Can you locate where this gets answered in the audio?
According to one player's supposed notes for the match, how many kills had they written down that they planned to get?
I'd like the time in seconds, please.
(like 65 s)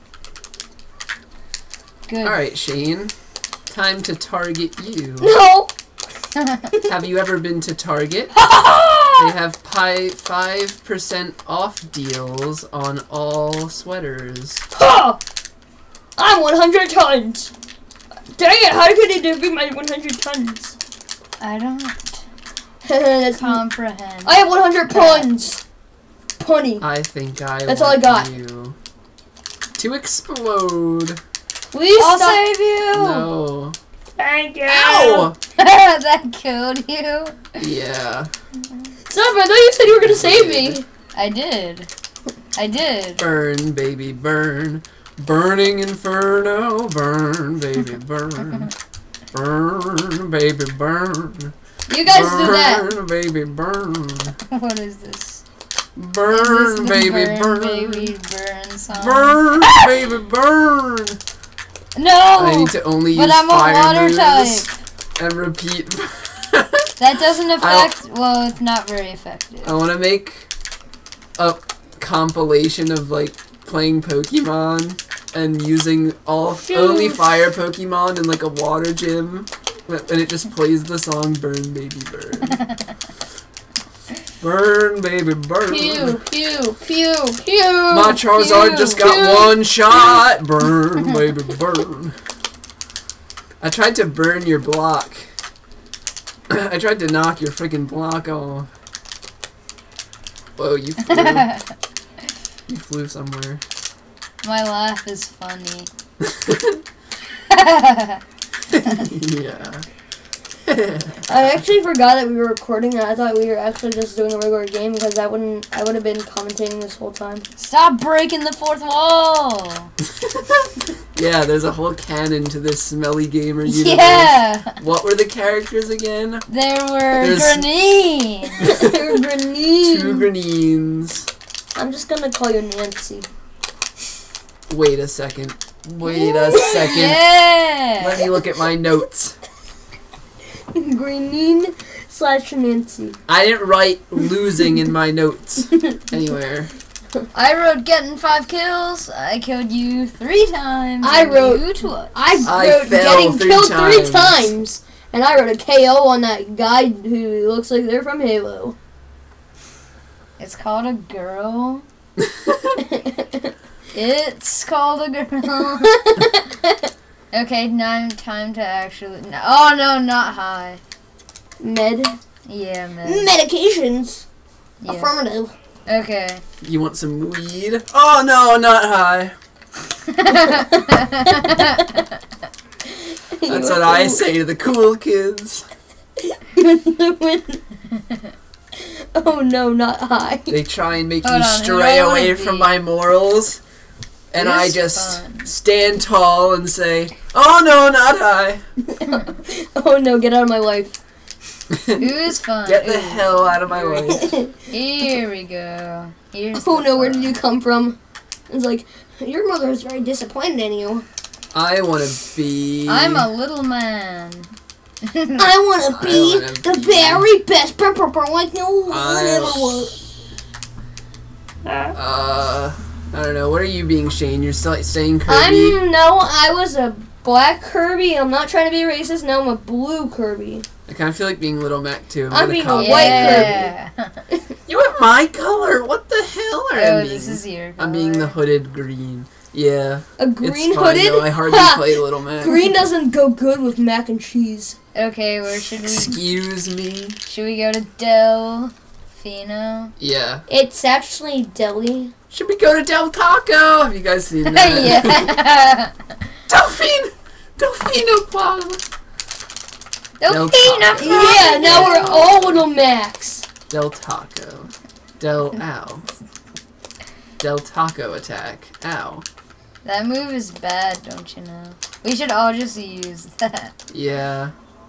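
148 s.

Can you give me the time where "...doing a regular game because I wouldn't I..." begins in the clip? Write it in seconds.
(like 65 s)
114 s.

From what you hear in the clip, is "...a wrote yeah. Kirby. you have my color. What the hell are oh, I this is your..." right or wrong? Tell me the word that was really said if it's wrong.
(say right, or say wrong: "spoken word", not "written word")
wrong: "white", not "wrote".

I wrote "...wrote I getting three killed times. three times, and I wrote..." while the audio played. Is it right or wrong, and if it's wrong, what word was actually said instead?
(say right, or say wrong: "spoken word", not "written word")
right.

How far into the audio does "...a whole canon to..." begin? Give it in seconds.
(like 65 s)
121 s.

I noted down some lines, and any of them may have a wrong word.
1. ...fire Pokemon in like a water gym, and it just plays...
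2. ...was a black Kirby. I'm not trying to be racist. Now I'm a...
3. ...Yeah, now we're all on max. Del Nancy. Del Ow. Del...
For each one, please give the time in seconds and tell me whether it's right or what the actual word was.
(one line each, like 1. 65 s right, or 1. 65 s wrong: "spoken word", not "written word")
1. 77 s right
2. 226 s right
3. 261 s wrong: "Taco", not "Nancy".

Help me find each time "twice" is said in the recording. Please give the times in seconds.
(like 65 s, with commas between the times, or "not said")
151 s.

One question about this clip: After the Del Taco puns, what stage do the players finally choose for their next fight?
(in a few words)
Delfino Plaza.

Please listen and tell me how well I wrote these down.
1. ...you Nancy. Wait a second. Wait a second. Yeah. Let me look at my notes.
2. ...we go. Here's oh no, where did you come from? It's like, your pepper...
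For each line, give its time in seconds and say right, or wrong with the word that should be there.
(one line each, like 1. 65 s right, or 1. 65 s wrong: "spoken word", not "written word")
1. 132 s right
2. 205 s wrong: "mother", not "pepper".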